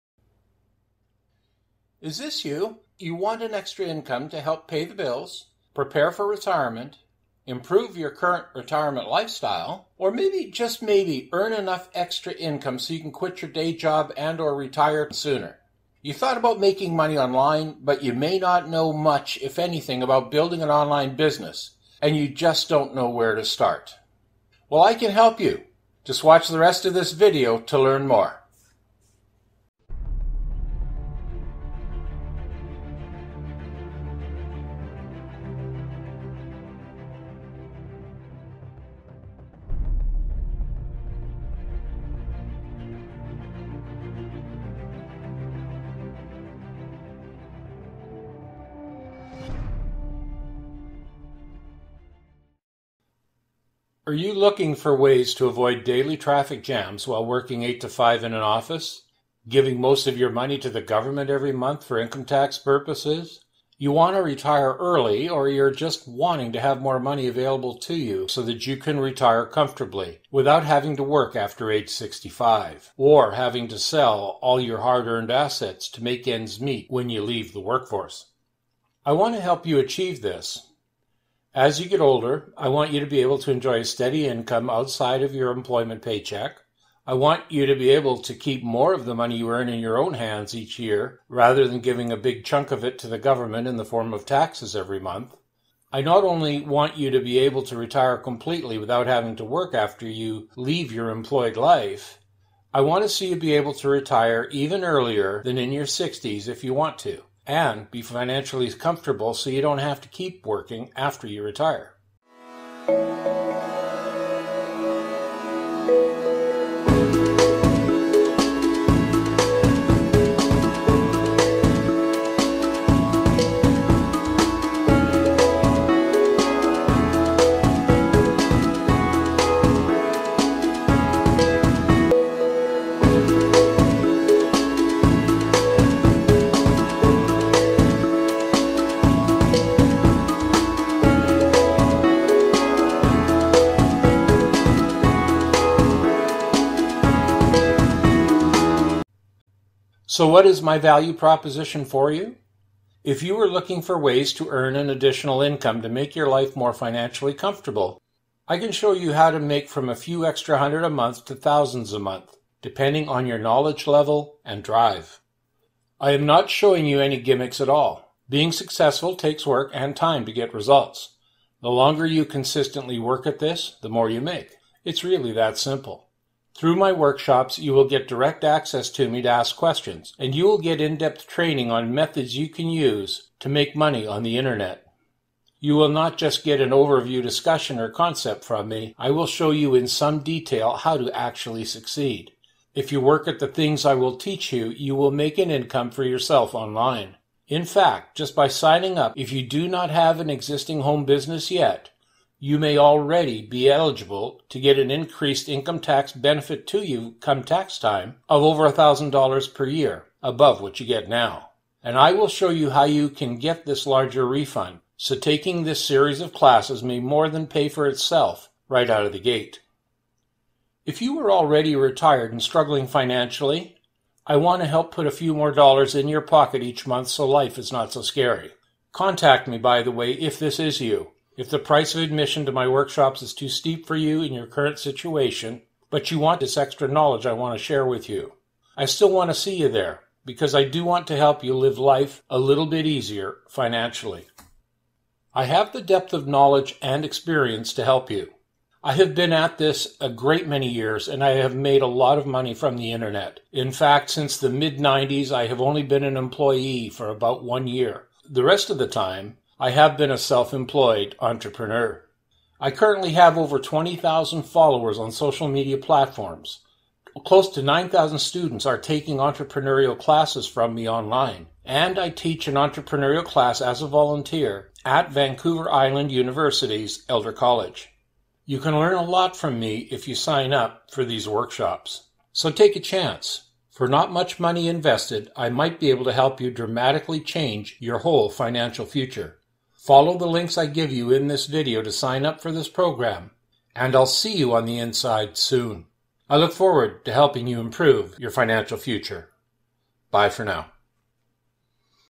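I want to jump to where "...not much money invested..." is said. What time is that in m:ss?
4:43.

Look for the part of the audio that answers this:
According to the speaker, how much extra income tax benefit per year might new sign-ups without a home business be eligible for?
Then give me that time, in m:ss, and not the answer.
3:28.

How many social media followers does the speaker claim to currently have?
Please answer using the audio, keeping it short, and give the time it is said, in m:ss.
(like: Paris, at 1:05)
over 20,000, at 4:23.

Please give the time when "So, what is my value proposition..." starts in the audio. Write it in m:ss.
2:30.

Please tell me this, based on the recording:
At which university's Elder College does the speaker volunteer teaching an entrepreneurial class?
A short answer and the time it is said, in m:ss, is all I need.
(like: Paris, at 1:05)
Vancouver Island University, at 4:35.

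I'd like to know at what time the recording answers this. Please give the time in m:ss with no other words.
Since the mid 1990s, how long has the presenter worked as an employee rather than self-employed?
4:17.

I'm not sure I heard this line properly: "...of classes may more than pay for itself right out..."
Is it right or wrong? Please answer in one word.
right.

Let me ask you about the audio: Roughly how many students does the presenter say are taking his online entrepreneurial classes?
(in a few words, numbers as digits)
close to 9,000.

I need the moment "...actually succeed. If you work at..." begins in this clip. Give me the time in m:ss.
3:11.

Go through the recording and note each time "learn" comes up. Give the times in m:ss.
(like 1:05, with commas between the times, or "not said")
0:27, 4:38.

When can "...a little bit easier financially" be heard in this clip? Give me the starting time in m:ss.
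4:02.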